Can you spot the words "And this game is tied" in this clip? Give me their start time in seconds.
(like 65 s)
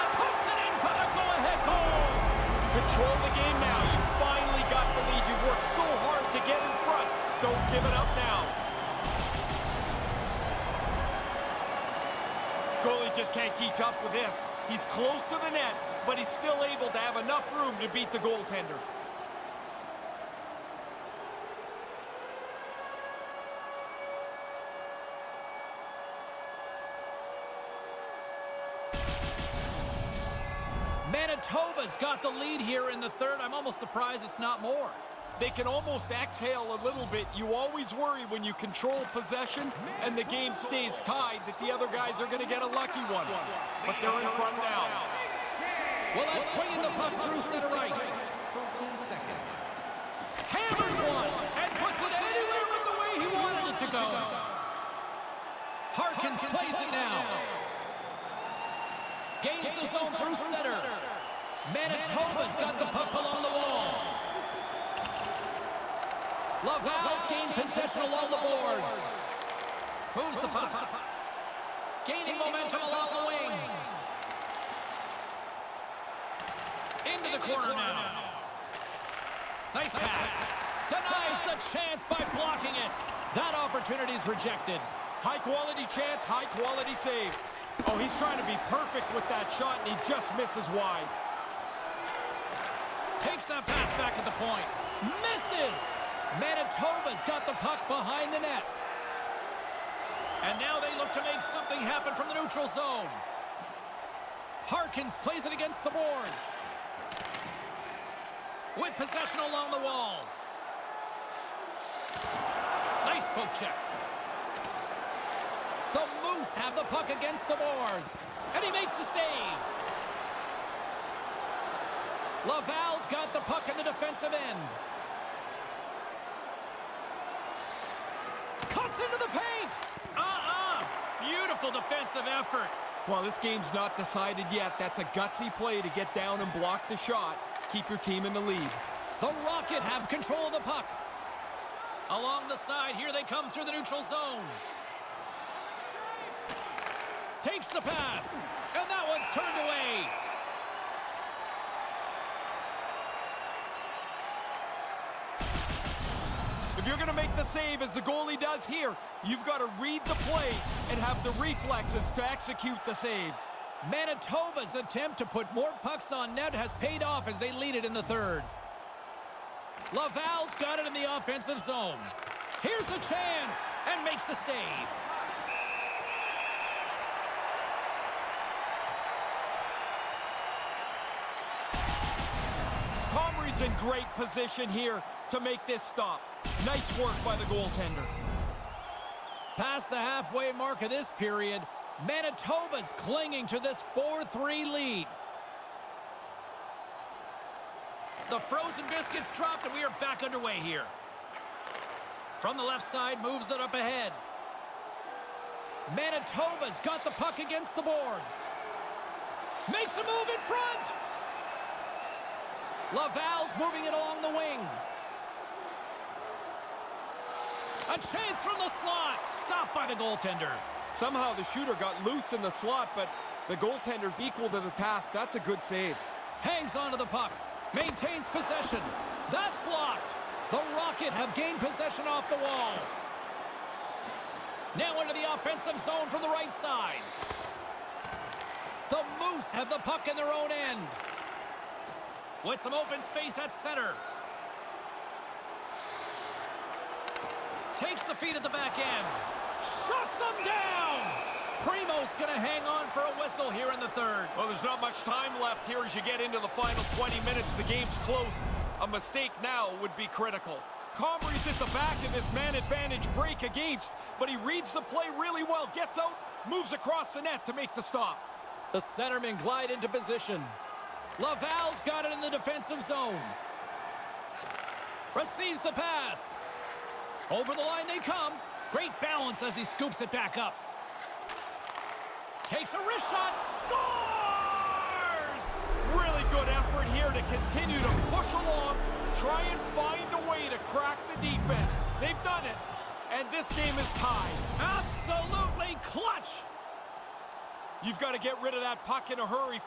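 293 s.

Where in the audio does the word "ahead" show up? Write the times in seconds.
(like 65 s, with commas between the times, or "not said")
1 s, 203 s.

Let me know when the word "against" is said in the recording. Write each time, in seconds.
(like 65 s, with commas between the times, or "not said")
105 s, 117 s, 207 s, 263 s.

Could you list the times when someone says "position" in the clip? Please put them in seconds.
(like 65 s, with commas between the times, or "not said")
184 s, 269 s.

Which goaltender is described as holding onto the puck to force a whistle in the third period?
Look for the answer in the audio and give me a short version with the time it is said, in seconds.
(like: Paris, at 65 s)
Primeau, at 251 s.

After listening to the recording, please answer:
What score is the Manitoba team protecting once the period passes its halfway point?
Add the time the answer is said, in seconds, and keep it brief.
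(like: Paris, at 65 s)
4-3, at 193 s.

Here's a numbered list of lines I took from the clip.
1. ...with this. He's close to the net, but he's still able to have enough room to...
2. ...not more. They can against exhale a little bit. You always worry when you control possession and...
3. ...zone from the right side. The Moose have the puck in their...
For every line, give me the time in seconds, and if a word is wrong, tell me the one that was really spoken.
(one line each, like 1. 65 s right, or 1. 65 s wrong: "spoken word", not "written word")
1. 14 s right
2. 34 s wrong: "almost", not "against"
3. 235 s right.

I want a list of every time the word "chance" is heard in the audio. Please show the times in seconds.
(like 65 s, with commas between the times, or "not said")
81 s, 85 s, 172 s, 217 s.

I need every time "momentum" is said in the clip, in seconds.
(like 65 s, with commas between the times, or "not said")
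72 s.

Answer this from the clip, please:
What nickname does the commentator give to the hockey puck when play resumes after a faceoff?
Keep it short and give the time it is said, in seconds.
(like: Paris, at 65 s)
frozen biscuits, at 198 s.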